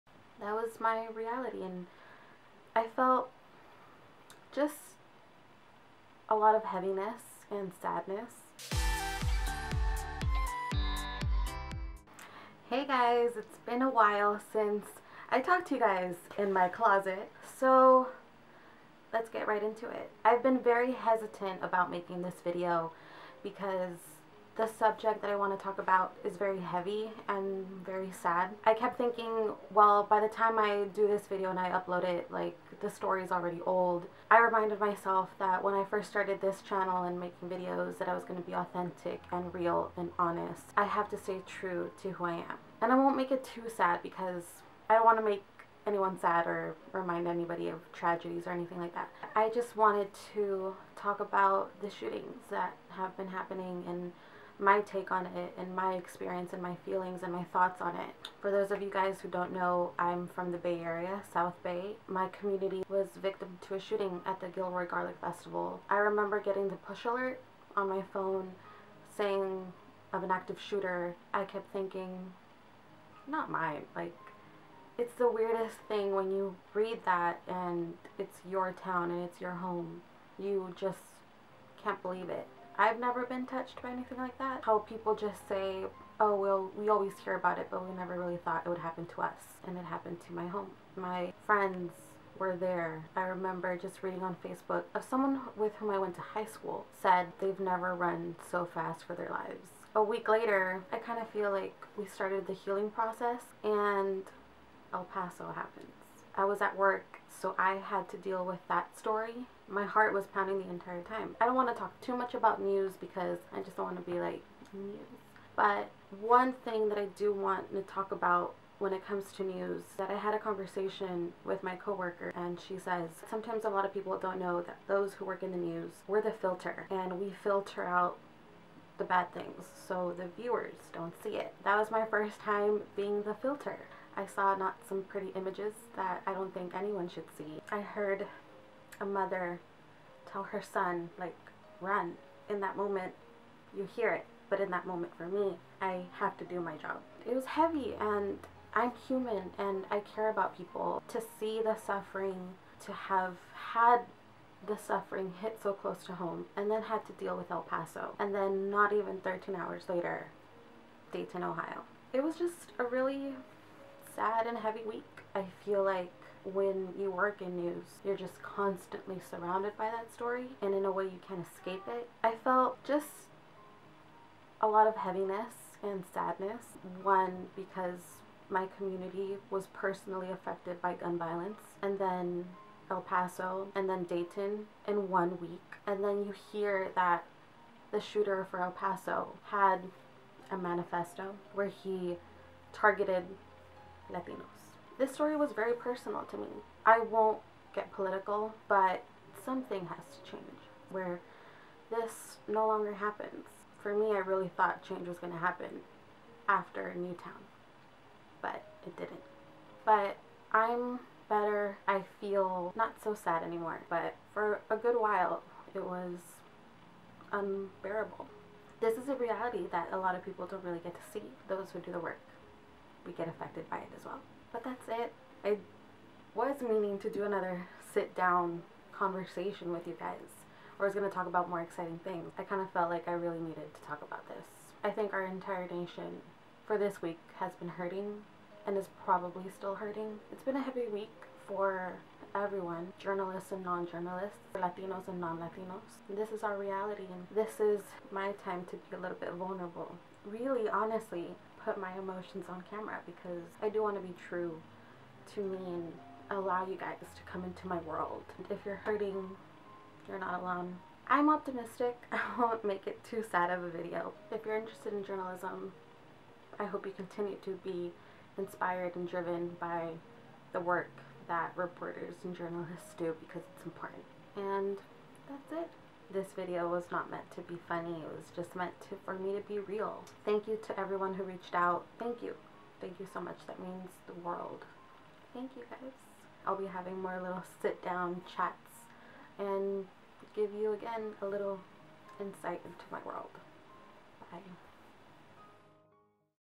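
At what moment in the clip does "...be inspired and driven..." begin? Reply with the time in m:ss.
4:27.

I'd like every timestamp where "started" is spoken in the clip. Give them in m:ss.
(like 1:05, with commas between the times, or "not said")
0:36, 1:42.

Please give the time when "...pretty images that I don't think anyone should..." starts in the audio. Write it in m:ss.
2:15.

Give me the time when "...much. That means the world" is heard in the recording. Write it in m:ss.
4:43.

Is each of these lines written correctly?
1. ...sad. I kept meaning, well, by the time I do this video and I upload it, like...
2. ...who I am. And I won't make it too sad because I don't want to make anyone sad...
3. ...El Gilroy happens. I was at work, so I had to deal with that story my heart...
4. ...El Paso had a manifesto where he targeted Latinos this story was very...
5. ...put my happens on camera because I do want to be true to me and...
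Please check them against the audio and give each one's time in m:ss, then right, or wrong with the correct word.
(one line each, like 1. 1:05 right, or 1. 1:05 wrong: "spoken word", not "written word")
1. 0:28 wrong: "thinking", not "meaning"
2. 0:42 right
3. 1:44 wrong: "Paso", not "Gilroy"
4. 3:08 right
5. 4:11 wrong: "emotions", not "happens".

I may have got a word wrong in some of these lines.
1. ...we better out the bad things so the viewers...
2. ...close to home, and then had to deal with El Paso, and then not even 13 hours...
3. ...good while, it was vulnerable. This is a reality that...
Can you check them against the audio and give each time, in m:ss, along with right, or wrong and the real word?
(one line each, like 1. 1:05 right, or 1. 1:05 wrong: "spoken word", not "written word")
1. 2:07 wrong: "filter", not "better"
2. 2:35 right
3. 3:34 wrong: "unbearable", not "vulnerable".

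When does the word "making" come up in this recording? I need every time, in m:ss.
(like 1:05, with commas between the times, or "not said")
0:21, 0:37.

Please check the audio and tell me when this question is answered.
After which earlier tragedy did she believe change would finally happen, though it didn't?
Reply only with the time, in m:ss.
3:26.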